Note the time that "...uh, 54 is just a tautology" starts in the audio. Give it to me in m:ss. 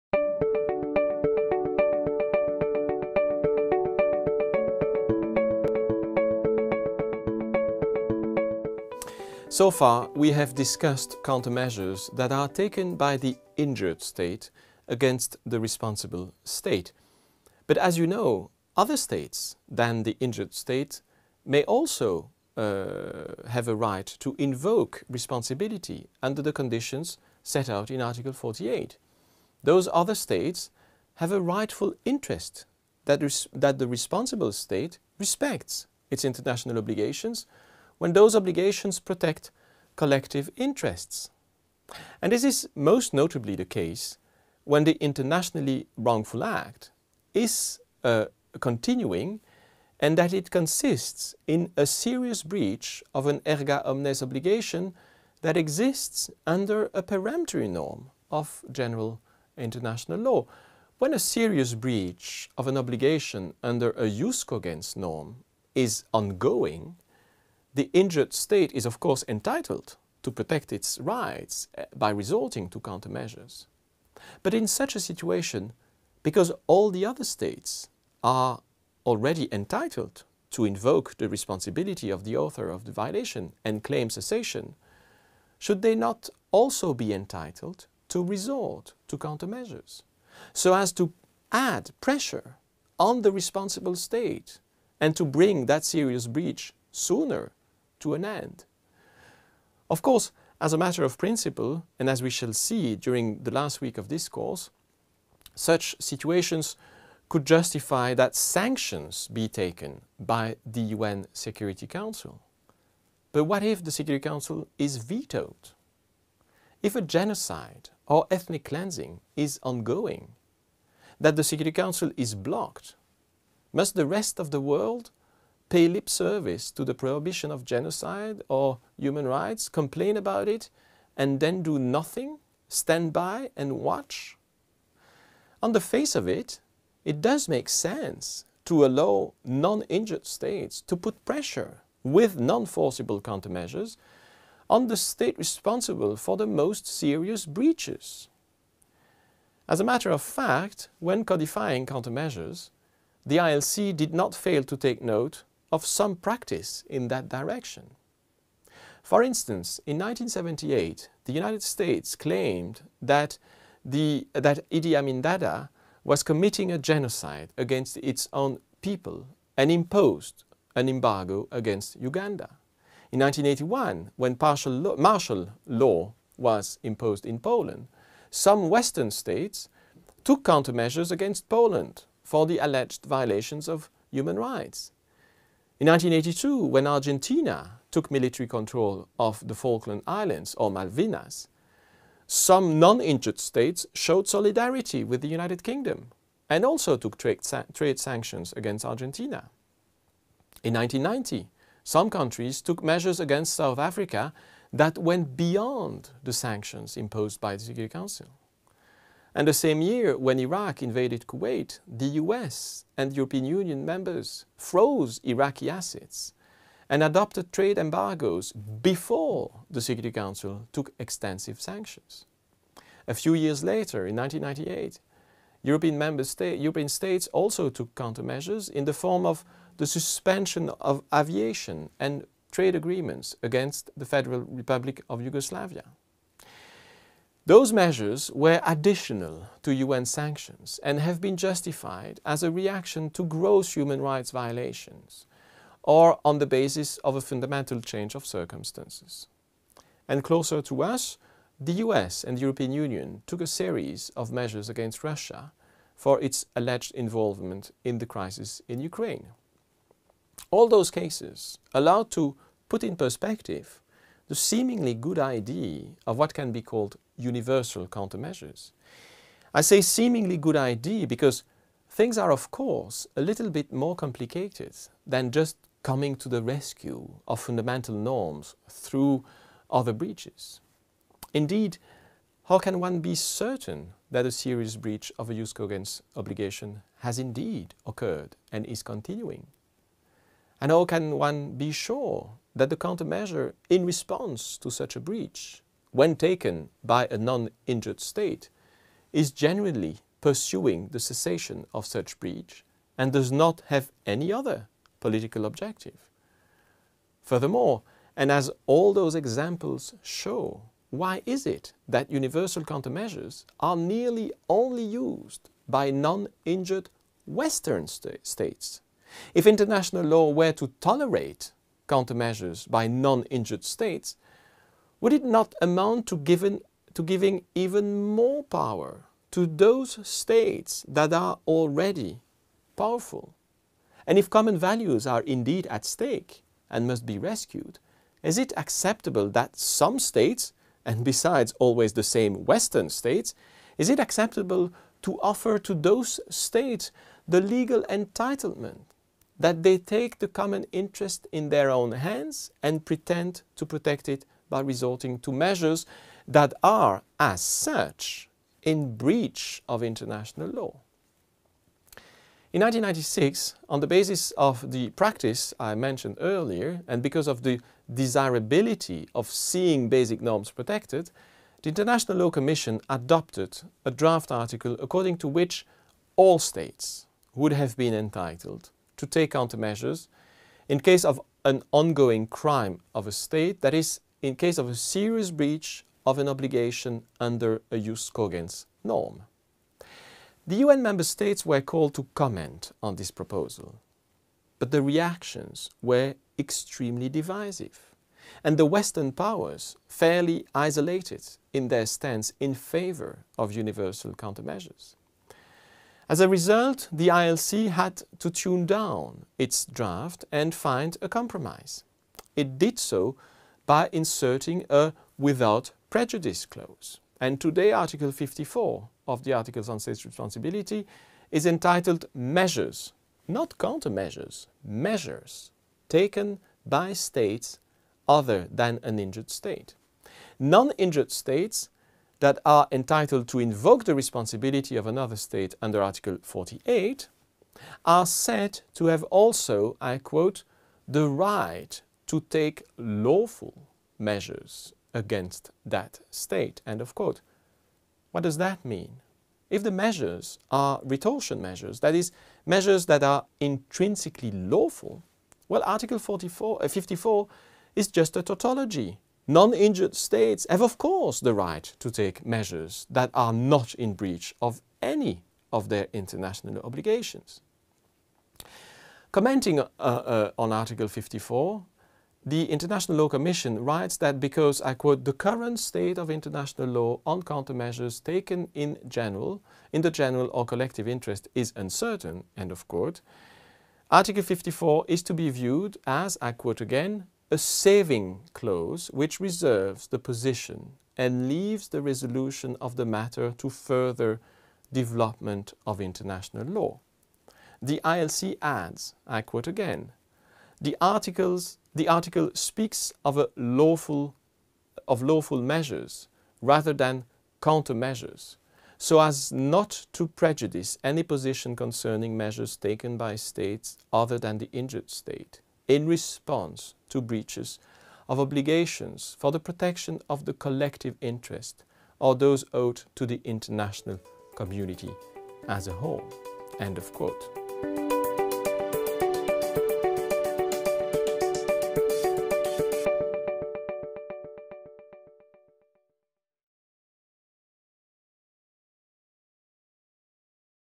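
7:36.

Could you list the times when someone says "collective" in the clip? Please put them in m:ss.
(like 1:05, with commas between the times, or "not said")
0:39, 8:00, 8:40.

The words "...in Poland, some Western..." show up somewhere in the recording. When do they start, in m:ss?
2:57.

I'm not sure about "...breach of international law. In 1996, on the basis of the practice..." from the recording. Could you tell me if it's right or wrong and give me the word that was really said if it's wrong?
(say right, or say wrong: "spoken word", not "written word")
right.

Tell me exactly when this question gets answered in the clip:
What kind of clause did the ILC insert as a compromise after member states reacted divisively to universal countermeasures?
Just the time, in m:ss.
6:55.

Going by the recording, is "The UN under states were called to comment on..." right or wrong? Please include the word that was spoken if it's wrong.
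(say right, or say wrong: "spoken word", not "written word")
wrong: "member", not "under".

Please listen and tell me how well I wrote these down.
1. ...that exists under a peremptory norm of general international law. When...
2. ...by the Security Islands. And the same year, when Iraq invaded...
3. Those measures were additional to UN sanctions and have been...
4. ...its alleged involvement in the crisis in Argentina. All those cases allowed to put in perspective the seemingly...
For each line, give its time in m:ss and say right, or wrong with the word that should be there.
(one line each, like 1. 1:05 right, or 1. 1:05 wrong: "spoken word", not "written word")
1. 0:55 right
2. 3:27 wrong: "Council", not "Islands"
3. 3:57 right
4. 4:16 wrong: "Ukraine", not "Argentina".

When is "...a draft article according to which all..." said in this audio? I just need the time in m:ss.
6:13.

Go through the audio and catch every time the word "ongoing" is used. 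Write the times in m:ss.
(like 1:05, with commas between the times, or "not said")
1:06, 1:59, 6:21.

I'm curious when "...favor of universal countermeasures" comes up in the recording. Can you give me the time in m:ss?
6:42.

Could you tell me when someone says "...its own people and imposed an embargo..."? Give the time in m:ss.
2:47.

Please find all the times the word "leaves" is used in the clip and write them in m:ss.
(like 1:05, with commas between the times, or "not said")
8:11.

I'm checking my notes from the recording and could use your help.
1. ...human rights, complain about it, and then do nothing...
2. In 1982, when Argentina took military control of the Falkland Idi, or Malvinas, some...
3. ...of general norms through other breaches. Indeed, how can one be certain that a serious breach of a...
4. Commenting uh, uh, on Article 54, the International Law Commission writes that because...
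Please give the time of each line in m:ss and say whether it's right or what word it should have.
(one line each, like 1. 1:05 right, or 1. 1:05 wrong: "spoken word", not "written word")
1. 2:08 right
2. 3:05 wrong: "Islands", not "Idi"
3. 4:37 wrong: "fundamental", not "general"
4. 7:49 right.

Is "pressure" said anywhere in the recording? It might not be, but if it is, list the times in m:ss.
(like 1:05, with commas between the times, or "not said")
1:32, 2:21.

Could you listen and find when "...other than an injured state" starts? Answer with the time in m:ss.
7:08.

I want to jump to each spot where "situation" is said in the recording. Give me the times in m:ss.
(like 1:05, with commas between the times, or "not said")
1:14, 1:45.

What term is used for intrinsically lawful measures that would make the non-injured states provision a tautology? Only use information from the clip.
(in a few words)
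retortion measures.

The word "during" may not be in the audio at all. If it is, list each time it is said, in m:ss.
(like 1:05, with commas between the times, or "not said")
1:42.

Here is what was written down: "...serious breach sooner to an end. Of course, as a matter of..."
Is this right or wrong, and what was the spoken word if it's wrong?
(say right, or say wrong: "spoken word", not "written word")
right.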